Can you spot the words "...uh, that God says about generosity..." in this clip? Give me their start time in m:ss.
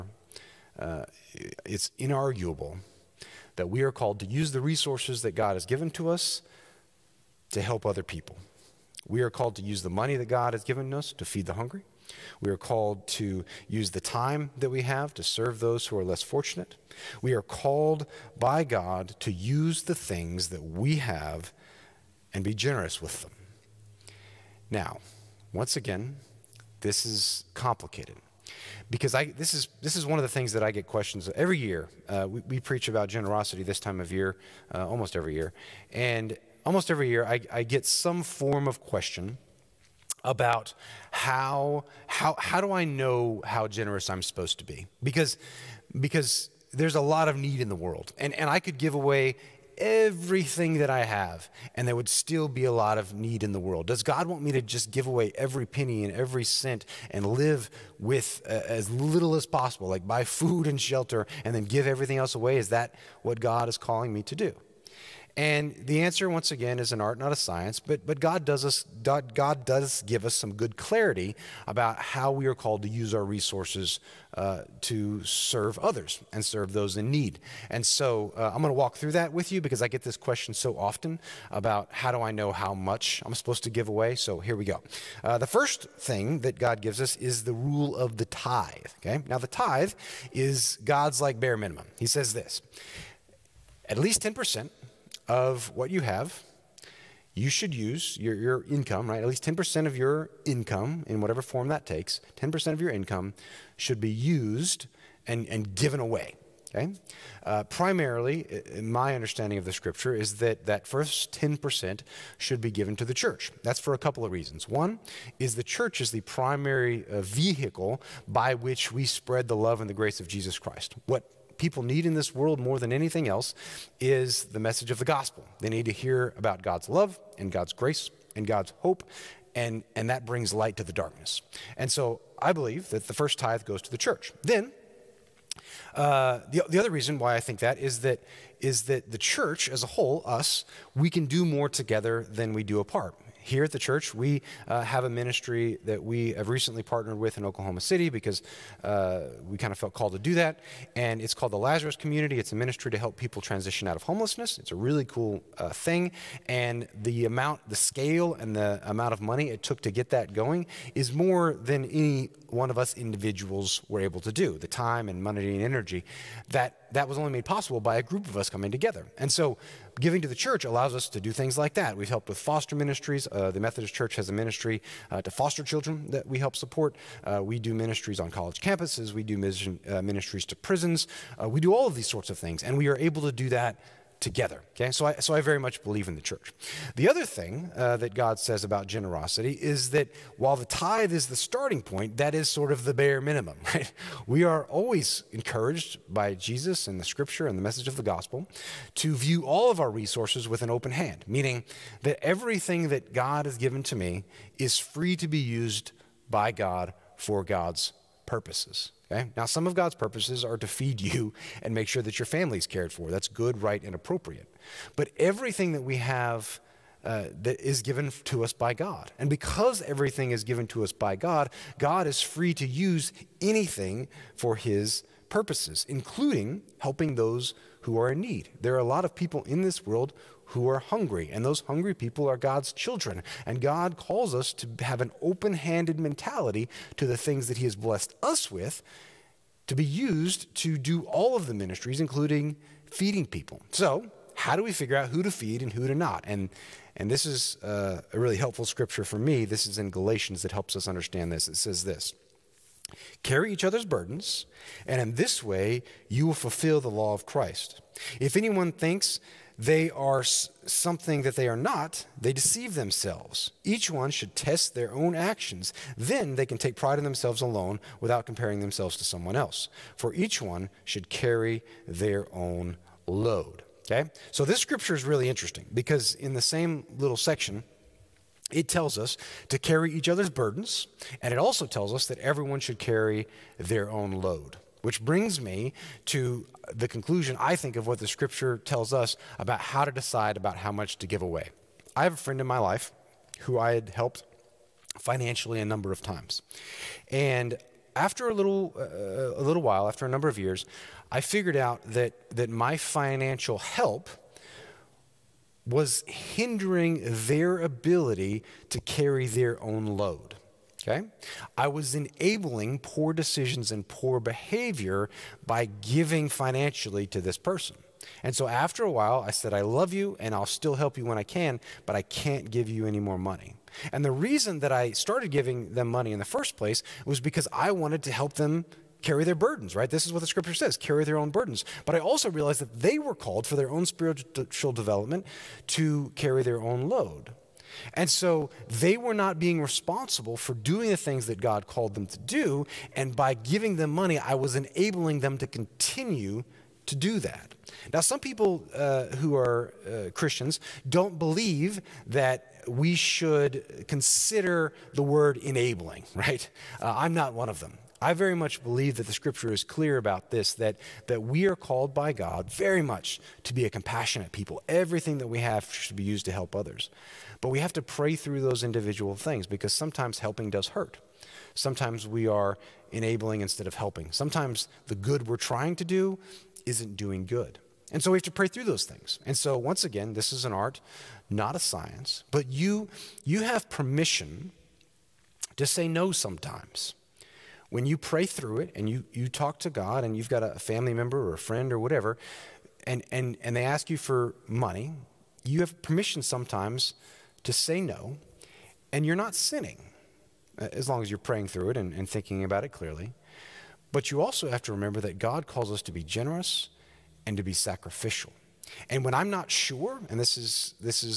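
3:07.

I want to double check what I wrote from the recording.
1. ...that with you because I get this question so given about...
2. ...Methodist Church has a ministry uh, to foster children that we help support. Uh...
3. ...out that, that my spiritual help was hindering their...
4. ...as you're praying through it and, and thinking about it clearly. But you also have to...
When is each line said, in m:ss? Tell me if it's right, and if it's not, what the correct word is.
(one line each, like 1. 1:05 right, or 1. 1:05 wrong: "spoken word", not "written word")
1. 1:19 wrong: "often", not "given"
2. 2:53 right
3. 5:01 wrong: "financial", not "spiritual"
4. 6:41 right.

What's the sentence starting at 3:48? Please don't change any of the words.
There are a lot of people in this world who are hungry.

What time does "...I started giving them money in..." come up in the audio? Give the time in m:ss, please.
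5:24.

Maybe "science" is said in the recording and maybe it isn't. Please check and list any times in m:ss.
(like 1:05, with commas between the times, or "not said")
1:07, 6:21.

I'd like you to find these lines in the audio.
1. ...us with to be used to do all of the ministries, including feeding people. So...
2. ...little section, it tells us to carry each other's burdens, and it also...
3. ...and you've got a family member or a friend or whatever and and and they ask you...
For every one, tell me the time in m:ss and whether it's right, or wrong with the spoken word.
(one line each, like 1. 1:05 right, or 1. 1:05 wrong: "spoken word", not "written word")
1. 3:58 right
2. 4:36 right
3. 6:30 right.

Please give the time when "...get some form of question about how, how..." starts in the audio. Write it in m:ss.
0:37.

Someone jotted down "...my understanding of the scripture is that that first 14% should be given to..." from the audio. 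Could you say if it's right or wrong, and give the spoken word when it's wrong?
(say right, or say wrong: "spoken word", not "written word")
wrong: "10", not "14".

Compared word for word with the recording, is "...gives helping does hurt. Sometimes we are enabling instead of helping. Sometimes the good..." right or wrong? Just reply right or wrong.
wrong.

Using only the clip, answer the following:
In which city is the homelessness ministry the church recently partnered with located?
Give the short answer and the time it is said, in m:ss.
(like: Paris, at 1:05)
Oklahoma City, at 2:27.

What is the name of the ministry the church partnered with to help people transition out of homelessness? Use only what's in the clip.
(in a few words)
Lazarus Community.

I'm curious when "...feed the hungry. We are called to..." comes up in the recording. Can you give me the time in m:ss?
0:11.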